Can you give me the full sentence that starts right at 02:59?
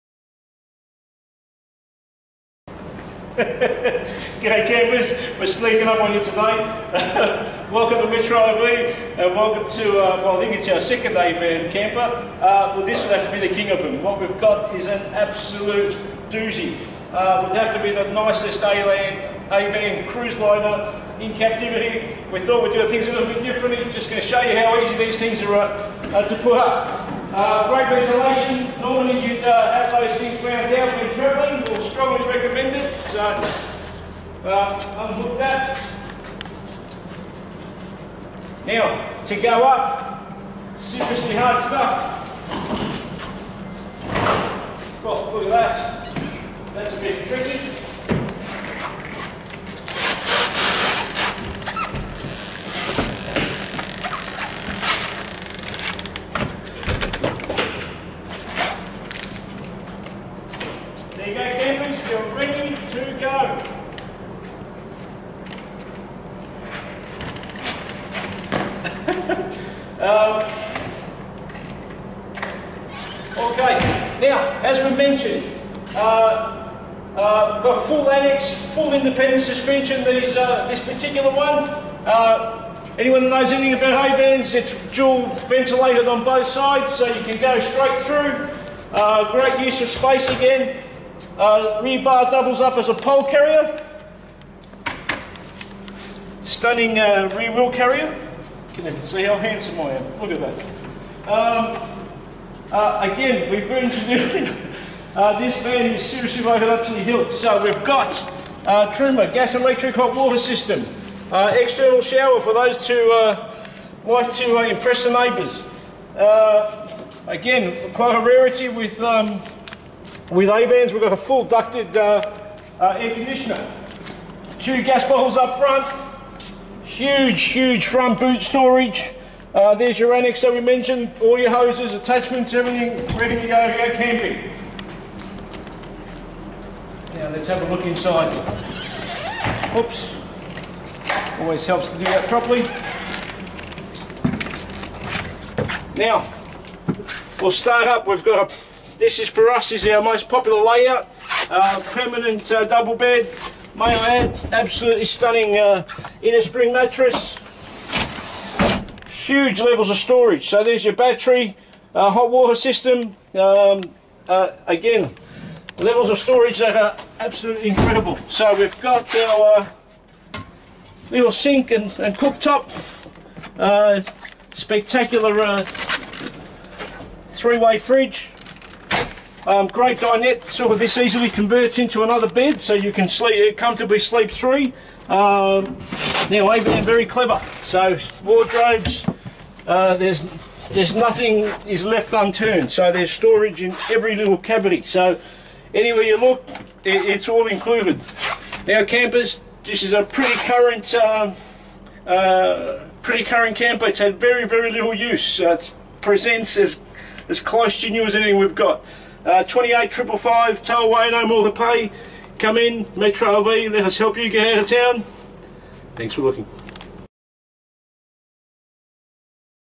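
Um, great dinette, sort of this easily converts into another bed, so you can sleep uh, comfortably sleep three.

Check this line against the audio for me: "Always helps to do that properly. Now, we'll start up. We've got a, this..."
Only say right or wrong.
right.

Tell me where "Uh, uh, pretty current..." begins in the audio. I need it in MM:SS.
03:20.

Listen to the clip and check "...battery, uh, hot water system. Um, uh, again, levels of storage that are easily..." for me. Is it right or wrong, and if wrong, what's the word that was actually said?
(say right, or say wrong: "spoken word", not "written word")
wrong: "absolutely", not "easily".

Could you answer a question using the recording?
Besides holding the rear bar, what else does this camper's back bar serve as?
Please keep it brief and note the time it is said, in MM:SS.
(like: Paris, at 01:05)
Pole carrier, at 01:32.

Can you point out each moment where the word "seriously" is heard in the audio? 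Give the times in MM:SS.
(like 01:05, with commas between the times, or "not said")
00:40, 01:46.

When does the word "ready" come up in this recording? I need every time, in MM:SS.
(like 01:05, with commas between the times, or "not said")
01:02, 02:13.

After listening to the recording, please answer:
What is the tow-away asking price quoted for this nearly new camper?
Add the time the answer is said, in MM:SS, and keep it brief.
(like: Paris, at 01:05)
$28,555, at 03:29.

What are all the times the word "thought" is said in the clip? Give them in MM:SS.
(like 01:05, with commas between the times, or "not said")
00:22.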